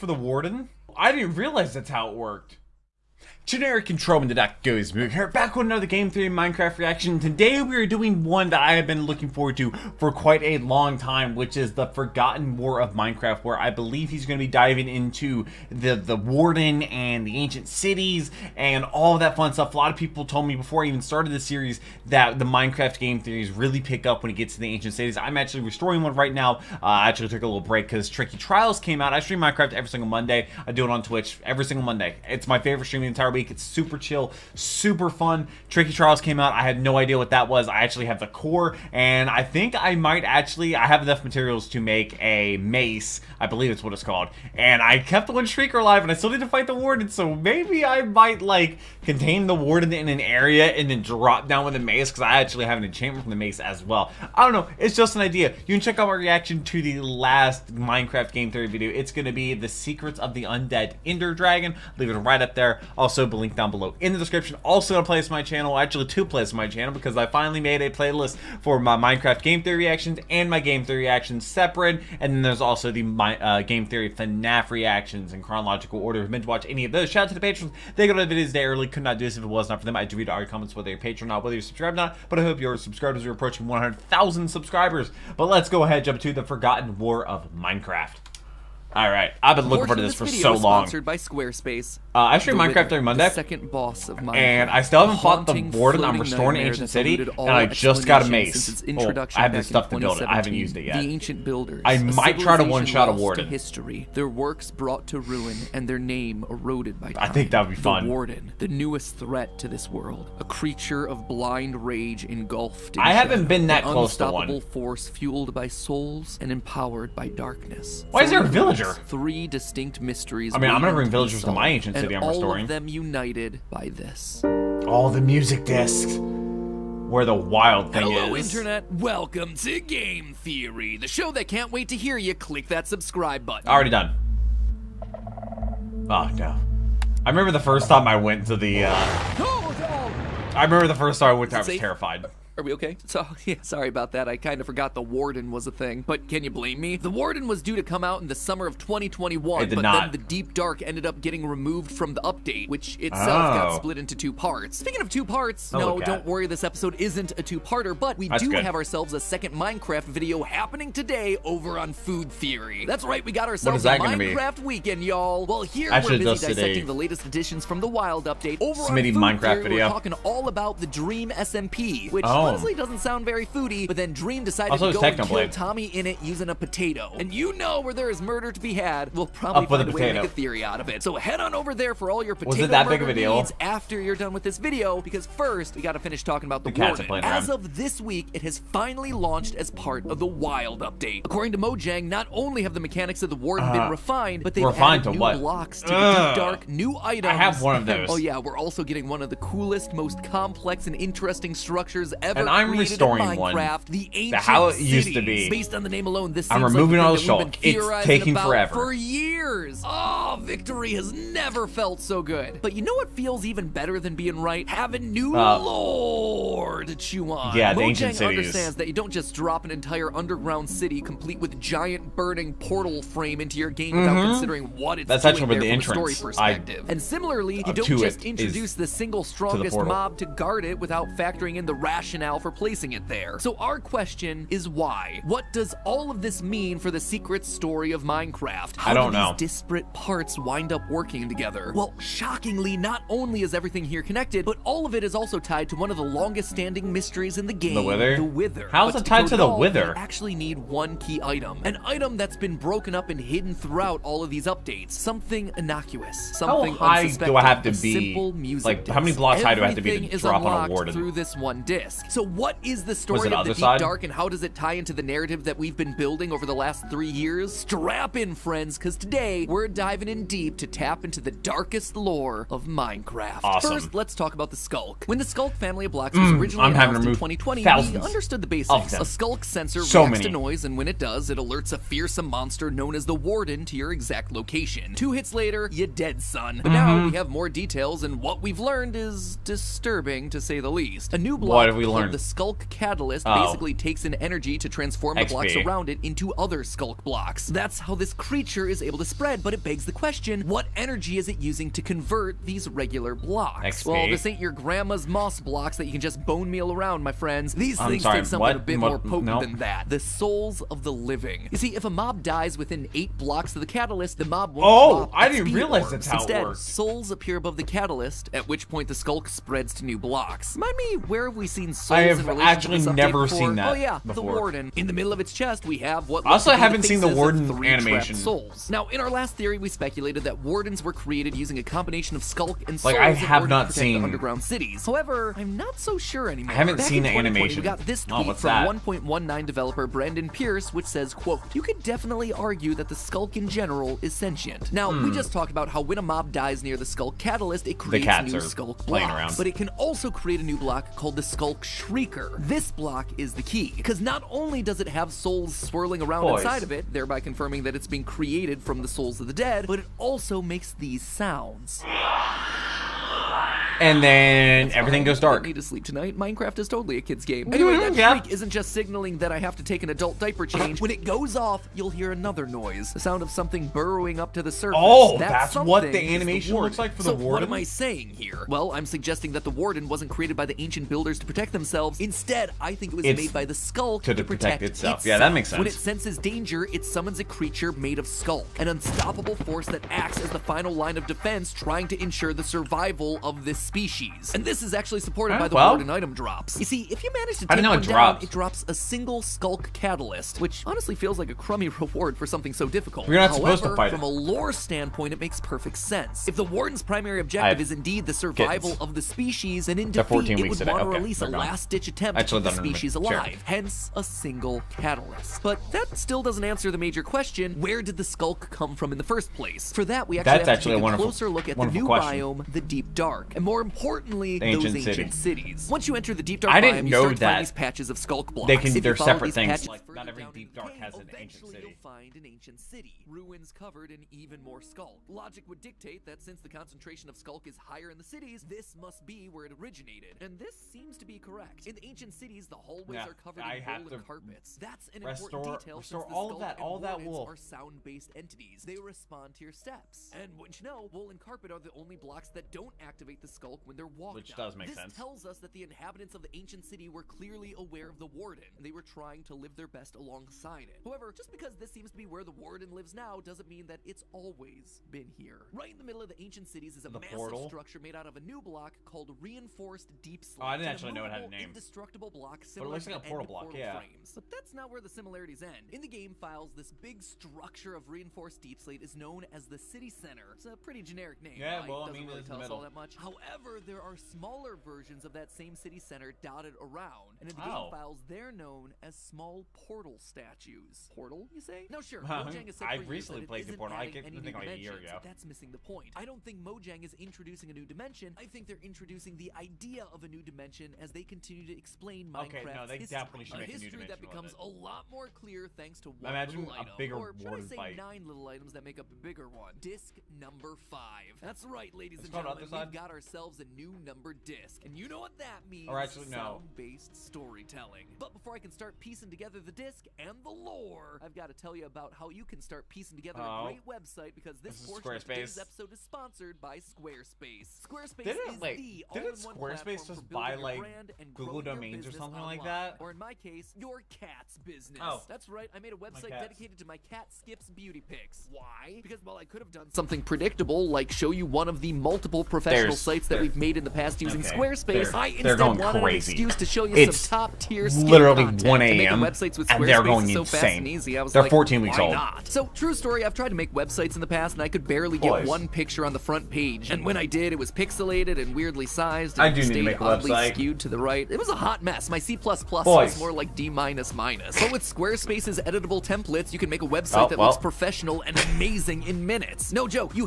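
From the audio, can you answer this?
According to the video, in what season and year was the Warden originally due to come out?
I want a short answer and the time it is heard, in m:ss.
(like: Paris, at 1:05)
summer of 2021, at 2:28.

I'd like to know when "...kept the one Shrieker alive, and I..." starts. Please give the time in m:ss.
0:44.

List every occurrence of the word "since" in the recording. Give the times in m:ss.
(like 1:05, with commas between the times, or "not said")
7:16, 7:26.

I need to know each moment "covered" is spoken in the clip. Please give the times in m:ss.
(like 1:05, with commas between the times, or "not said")
7:13, 7:23.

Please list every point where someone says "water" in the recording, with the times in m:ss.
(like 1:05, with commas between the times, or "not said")
not said.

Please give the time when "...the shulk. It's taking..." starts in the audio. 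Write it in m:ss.
3:27.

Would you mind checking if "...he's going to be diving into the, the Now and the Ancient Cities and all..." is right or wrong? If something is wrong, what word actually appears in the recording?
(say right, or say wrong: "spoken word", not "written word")
wrong: "Warden", not "Now".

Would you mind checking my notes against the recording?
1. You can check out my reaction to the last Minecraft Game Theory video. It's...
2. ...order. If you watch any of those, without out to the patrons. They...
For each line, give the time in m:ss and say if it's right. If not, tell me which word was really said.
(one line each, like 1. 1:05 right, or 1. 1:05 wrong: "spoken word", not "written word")
1. 0:55 right
2. 1:16 wrong: "shout", not "without".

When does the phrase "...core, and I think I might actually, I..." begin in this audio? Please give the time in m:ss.
0:38.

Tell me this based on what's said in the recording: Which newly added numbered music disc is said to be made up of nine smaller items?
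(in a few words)
Disc number 5.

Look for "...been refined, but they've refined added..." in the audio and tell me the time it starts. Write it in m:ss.
3:13.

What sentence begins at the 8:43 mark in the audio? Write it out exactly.
a great website because this, this portion of today's episode is sponsored by Squarespace.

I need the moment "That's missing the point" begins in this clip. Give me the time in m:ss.
8:15.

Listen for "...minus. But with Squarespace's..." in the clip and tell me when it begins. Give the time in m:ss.
9:23.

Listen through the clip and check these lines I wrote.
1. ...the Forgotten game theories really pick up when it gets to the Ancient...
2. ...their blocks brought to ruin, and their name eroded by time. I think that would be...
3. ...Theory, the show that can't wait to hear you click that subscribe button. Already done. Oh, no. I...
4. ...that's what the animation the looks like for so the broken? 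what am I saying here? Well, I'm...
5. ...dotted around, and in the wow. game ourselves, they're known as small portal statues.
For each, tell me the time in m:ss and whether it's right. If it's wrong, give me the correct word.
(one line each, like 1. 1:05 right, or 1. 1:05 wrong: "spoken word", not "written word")
1. 0:22 wrong: "Minecraft", not "Forgotten"
2. 1:44 wrong: "works", not "blocks"
3. 2:10 right
4. 6:15 wrong: "warden", not "broken"
5. 8:06 wrong: "files", not "ourselves".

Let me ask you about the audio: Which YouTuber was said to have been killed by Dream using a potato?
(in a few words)
TommyInnit.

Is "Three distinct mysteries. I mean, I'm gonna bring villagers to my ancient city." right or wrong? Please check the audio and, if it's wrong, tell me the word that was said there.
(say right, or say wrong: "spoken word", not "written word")
right.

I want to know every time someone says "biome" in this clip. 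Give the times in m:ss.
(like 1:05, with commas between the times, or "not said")
7:02, 7:06.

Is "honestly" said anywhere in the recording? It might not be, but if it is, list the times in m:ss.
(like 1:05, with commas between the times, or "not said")
2:52, 6:40.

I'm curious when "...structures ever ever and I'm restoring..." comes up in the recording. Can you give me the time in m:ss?
3:21.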